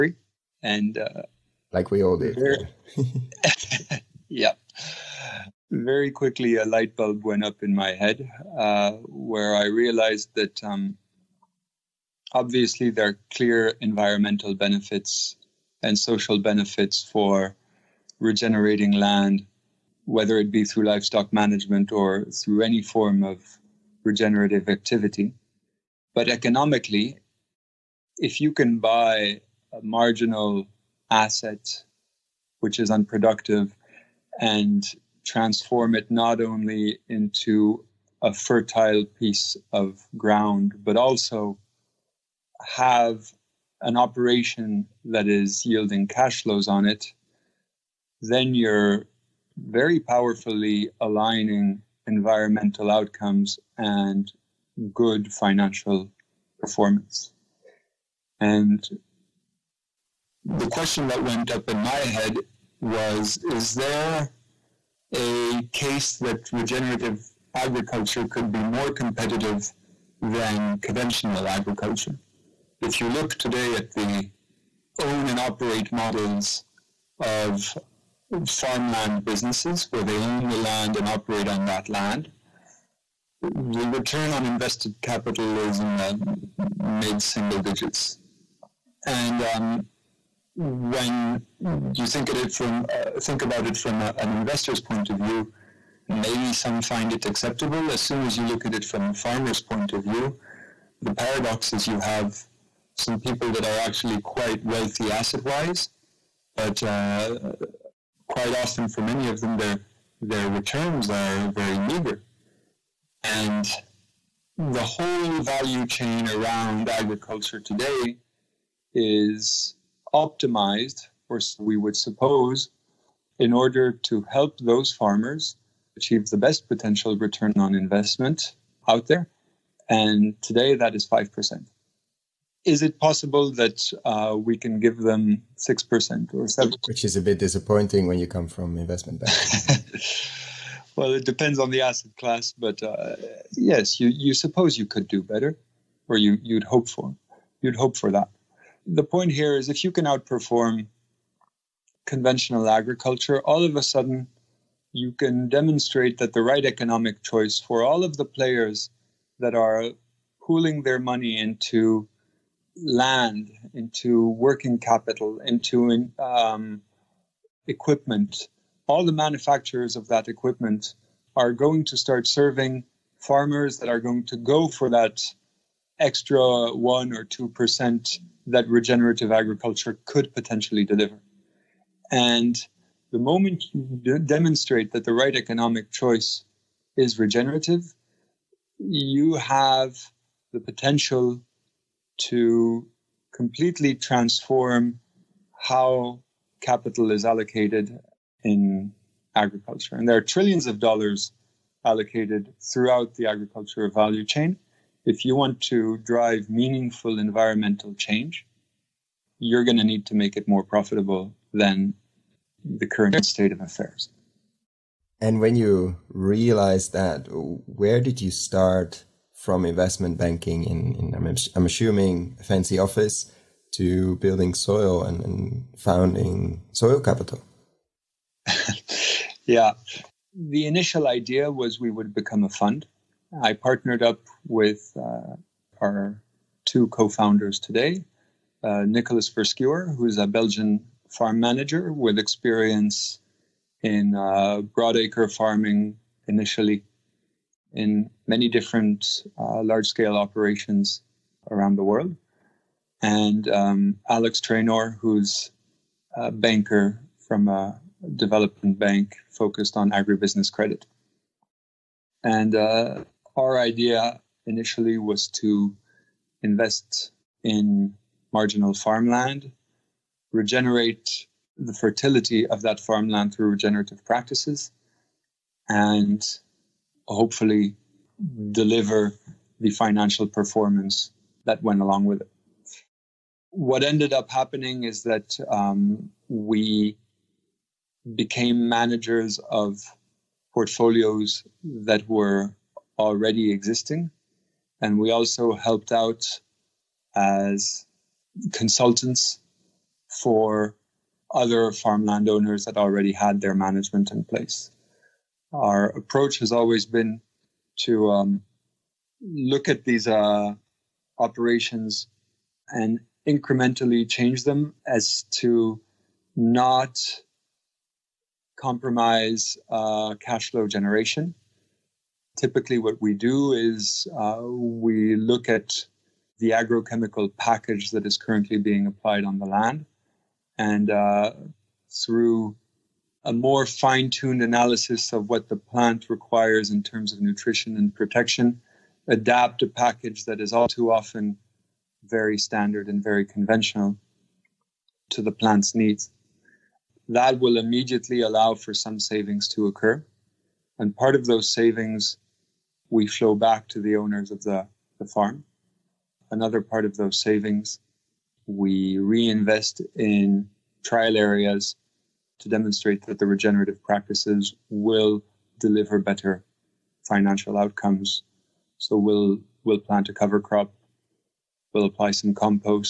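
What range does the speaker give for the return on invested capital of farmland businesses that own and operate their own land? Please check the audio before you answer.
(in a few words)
mid single digits.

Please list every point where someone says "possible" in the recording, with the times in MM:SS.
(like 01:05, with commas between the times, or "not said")
02:12.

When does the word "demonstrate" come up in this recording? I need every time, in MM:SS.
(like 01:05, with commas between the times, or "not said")
02:35, 03:04, 06:02.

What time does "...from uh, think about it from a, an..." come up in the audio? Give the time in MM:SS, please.
01:32.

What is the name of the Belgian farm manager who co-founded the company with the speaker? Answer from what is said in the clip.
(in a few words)
Nicolas Verschuere.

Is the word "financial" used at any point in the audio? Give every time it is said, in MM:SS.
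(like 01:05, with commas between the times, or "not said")
00:55, 04:39, 06:07.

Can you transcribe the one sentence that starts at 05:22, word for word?
Typically, what we do is uh, we look at the agrochemical package that is currently being applied on the land.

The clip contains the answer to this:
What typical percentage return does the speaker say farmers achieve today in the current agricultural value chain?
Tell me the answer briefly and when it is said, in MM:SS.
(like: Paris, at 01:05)
5%, at 02:11.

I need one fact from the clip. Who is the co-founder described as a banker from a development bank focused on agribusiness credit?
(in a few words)
Alex Trainor.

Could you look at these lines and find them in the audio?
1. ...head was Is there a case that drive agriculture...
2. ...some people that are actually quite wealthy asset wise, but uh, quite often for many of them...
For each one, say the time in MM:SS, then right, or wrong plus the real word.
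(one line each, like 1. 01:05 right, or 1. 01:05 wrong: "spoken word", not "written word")
1. 01:02 wrong: "regenerative", not "drive"
2. 01:42 right.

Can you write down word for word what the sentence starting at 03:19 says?
And there are trillions of dollars allocated throughout the agricultural value chain.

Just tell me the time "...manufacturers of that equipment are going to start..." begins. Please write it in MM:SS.
02:49.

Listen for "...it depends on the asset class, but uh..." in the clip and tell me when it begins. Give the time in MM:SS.
02:21.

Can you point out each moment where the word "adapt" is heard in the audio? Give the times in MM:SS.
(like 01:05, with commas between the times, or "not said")
05:39.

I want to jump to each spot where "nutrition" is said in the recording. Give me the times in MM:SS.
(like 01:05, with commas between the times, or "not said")
05:37.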